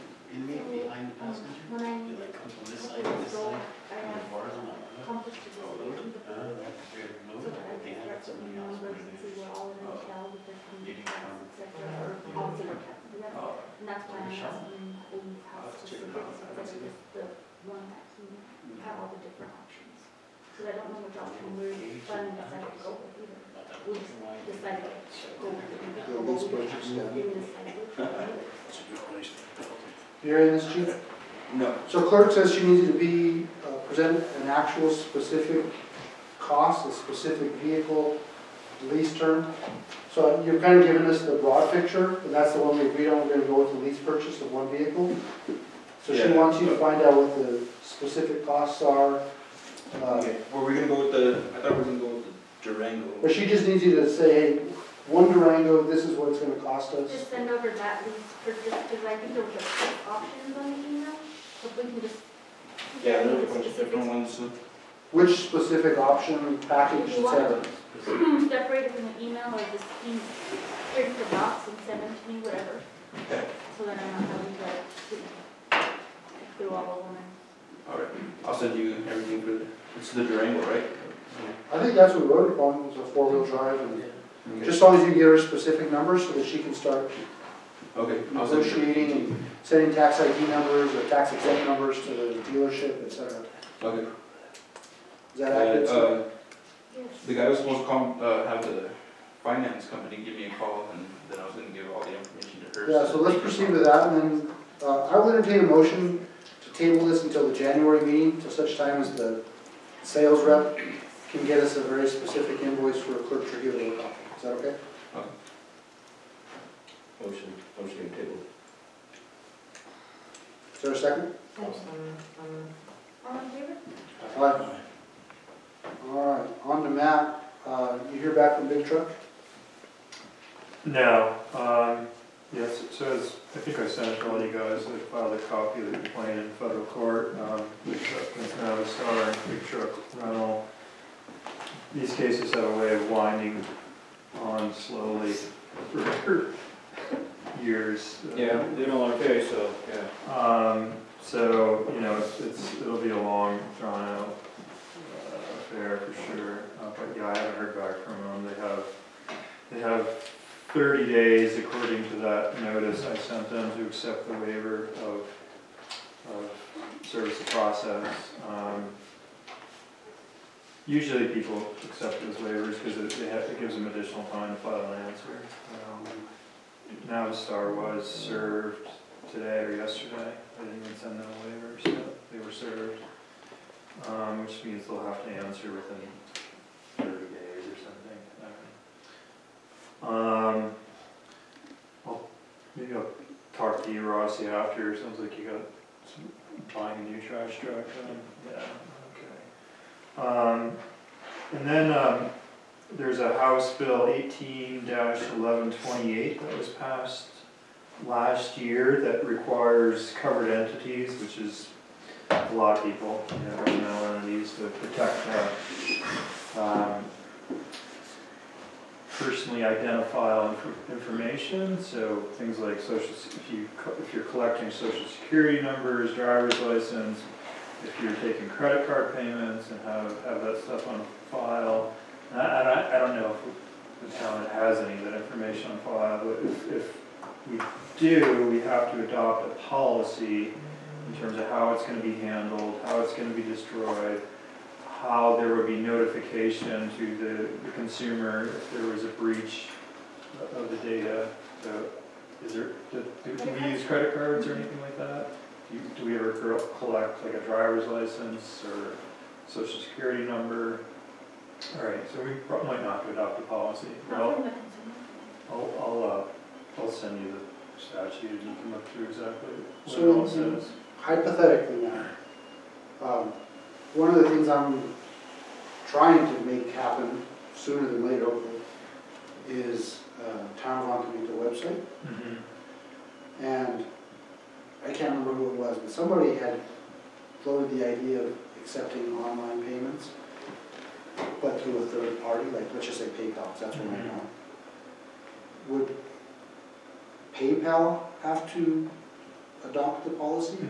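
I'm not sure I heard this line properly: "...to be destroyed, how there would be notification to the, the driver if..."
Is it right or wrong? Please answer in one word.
wrong.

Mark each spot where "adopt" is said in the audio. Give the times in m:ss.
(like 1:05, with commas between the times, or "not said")
3:59, 4:23, 4:59.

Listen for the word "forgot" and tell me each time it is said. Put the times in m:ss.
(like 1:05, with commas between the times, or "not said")
not said.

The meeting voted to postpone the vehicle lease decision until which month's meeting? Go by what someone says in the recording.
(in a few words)
January.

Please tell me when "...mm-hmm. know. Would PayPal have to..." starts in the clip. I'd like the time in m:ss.
4:54.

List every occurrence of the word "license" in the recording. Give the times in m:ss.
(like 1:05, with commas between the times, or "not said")
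3:46, 4:17.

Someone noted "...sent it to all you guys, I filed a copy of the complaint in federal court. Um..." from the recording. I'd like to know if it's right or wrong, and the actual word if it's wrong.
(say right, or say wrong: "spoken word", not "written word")
right.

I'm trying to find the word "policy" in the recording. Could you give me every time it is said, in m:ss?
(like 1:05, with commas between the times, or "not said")
3:59, 4:23, 5:00.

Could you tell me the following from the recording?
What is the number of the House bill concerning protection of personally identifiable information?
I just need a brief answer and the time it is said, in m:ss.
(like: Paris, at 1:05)
House Bill 18-1128, at 3:23.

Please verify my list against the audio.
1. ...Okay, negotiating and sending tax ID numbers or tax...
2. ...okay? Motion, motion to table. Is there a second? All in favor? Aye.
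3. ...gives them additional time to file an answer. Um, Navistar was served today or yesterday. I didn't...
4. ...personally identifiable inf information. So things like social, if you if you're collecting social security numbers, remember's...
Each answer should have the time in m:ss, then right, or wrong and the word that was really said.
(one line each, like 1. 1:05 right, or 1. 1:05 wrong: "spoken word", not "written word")
1. 1:27 right
2. 1:54 right
3. 2:53 right
4. 3:39 wrong: "driver", not "remember".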